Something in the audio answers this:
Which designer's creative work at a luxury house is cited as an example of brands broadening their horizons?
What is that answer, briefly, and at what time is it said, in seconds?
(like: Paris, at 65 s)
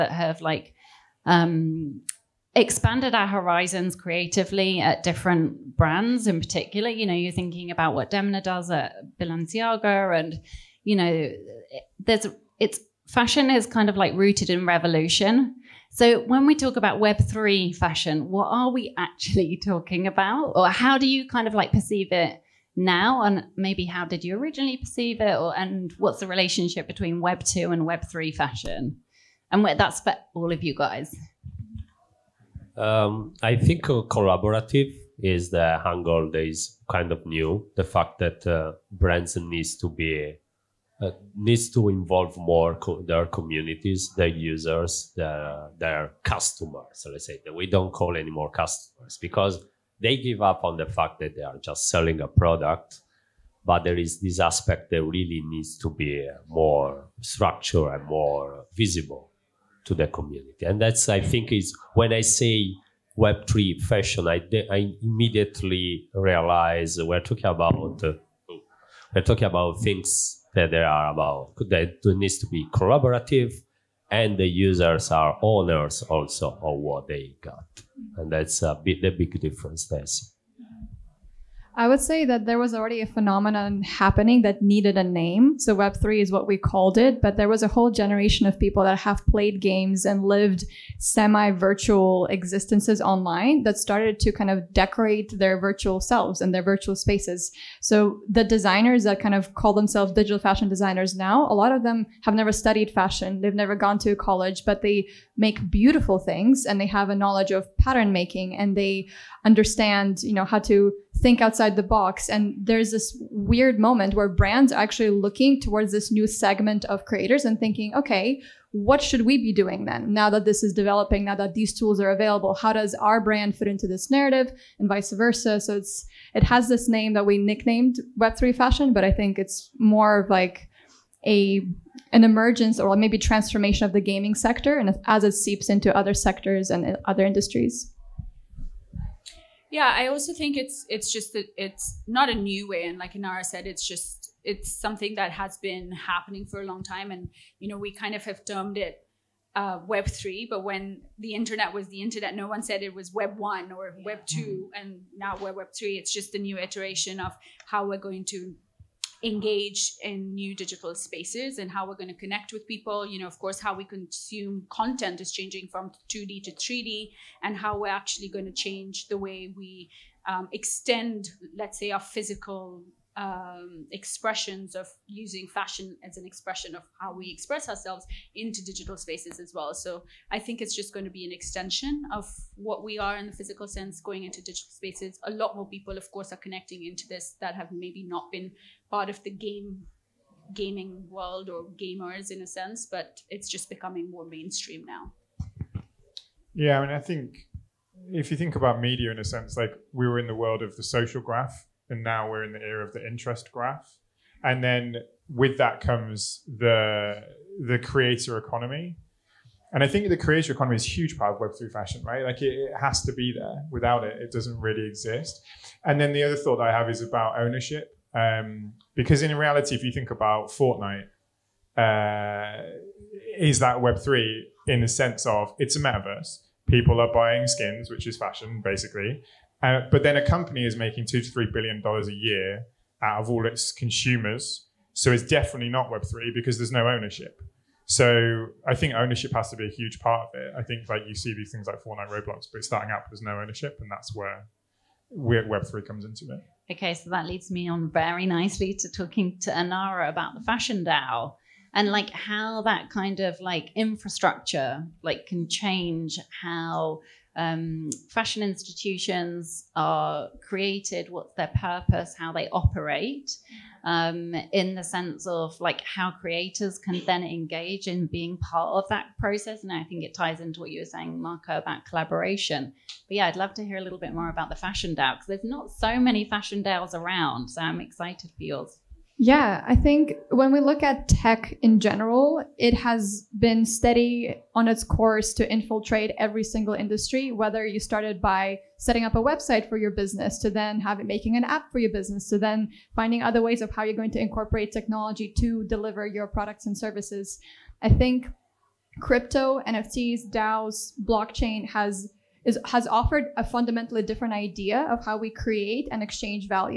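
Demna, at 8 s.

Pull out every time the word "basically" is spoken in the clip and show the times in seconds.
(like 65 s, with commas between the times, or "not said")
228 s.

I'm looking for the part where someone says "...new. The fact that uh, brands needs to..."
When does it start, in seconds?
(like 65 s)
37 s.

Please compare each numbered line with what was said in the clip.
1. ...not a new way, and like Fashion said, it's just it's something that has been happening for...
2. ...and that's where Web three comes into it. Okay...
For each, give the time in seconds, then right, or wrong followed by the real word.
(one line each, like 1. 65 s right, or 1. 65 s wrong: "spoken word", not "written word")
1. 142 s wrong: "Enara", not "Fashion"
2. 243 s right.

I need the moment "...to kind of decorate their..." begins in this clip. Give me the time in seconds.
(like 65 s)
94 s.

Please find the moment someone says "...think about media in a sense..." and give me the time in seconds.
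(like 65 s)
198 s.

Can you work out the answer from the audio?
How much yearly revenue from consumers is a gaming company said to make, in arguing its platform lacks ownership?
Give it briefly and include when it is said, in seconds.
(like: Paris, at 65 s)
2 to 3 billion dollars, at 231 s.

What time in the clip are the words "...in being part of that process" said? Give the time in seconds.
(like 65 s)
267 s.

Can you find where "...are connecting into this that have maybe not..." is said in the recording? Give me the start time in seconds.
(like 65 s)
186 s.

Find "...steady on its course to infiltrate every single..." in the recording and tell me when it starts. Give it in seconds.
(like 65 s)
283 s.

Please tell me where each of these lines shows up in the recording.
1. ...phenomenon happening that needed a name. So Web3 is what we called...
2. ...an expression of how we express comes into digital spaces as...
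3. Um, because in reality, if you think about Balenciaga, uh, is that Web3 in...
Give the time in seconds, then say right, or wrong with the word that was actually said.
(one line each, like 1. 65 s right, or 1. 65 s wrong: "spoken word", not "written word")
1. 83 s right
2. 176 s wrong: "ourselves", not "comes"
3. 218 s wrong: "Fortnite", not "Balenciaga".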